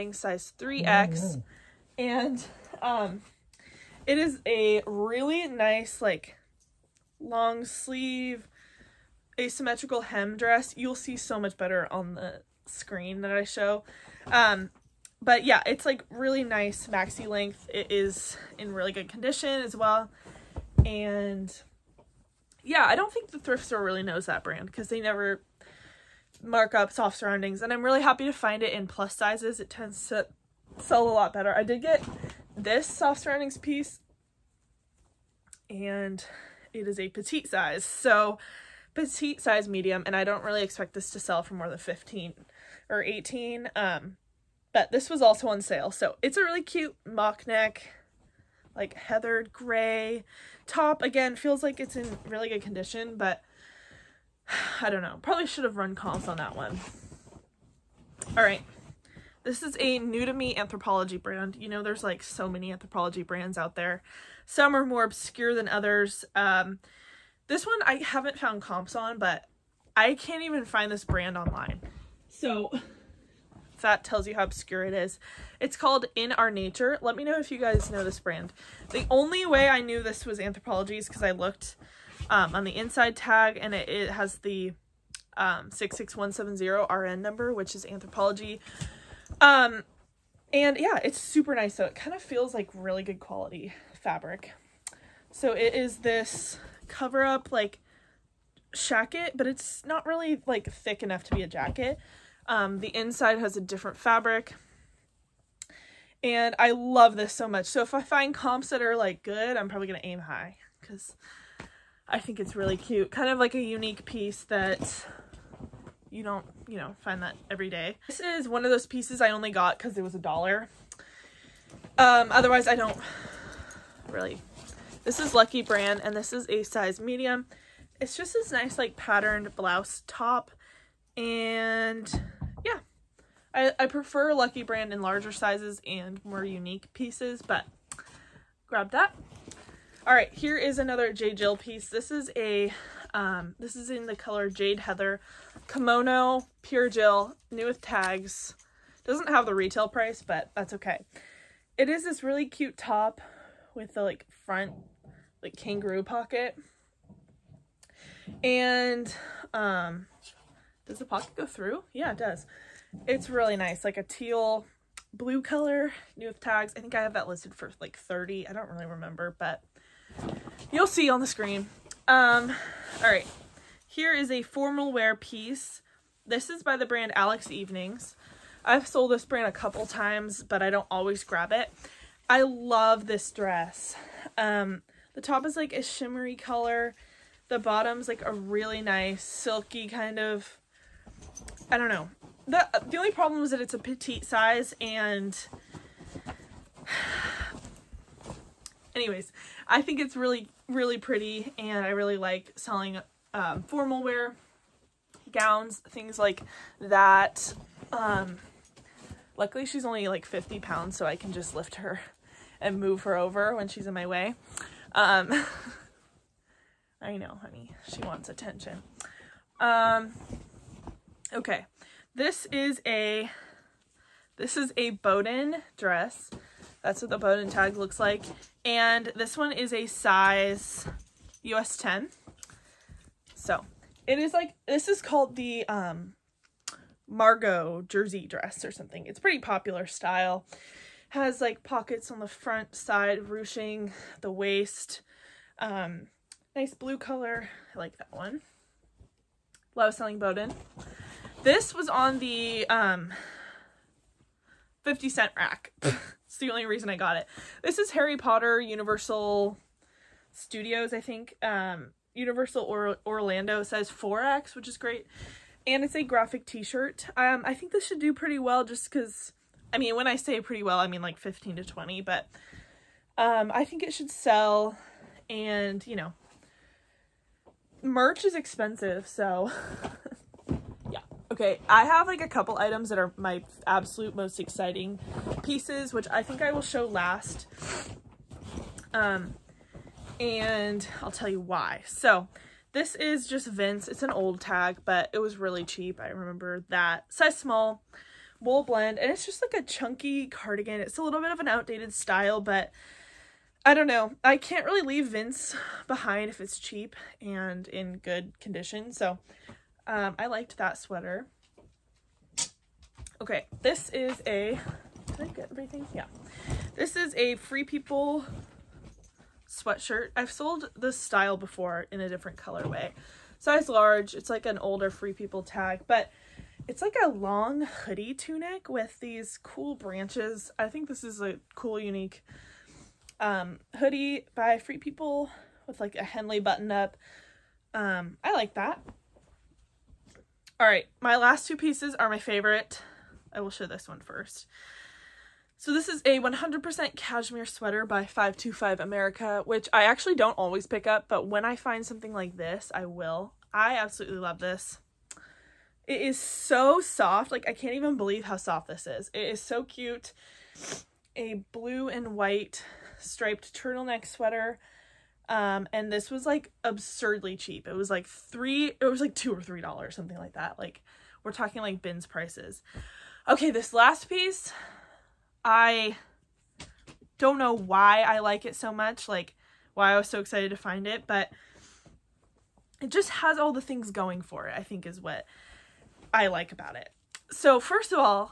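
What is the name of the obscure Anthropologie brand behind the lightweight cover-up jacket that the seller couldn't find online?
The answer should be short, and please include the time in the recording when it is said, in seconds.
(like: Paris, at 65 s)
In Our Nature, at 76 s.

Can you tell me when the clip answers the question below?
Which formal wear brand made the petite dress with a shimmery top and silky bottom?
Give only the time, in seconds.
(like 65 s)
177 s.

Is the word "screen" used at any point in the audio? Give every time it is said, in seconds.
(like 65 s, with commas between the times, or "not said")
12 s, 171 s.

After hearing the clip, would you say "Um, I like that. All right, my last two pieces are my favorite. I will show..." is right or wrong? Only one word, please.
right.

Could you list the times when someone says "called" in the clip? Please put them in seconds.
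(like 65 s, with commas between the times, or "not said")
75 s, 235 s.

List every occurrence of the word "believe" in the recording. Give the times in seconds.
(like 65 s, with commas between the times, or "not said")
357 s.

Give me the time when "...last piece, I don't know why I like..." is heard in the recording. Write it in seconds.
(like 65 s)
373 s.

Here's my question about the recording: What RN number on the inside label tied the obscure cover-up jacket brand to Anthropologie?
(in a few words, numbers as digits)
66170.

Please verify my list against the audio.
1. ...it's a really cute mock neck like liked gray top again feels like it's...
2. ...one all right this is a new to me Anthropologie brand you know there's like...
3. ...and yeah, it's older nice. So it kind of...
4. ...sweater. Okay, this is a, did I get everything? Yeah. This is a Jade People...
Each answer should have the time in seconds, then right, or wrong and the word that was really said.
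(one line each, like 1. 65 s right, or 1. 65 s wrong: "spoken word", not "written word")
1. 46 s wrong: "heathered", not "liked"
2. 56 s right
3. 90 s wrong: "super", not "older"
4. 310 s wrong: "Free", not "Jade".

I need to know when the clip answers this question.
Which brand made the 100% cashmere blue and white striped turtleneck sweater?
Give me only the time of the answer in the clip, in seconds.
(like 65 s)
348 s.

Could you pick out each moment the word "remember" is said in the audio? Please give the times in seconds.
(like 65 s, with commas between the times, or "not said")
168 s, 296 s.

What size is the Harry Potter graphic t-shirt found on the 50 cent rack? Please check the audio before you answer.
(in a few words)
4X.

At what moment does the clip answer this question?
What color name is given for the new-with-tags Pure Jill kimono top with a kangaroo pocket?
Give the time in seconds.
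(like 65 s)
144 s.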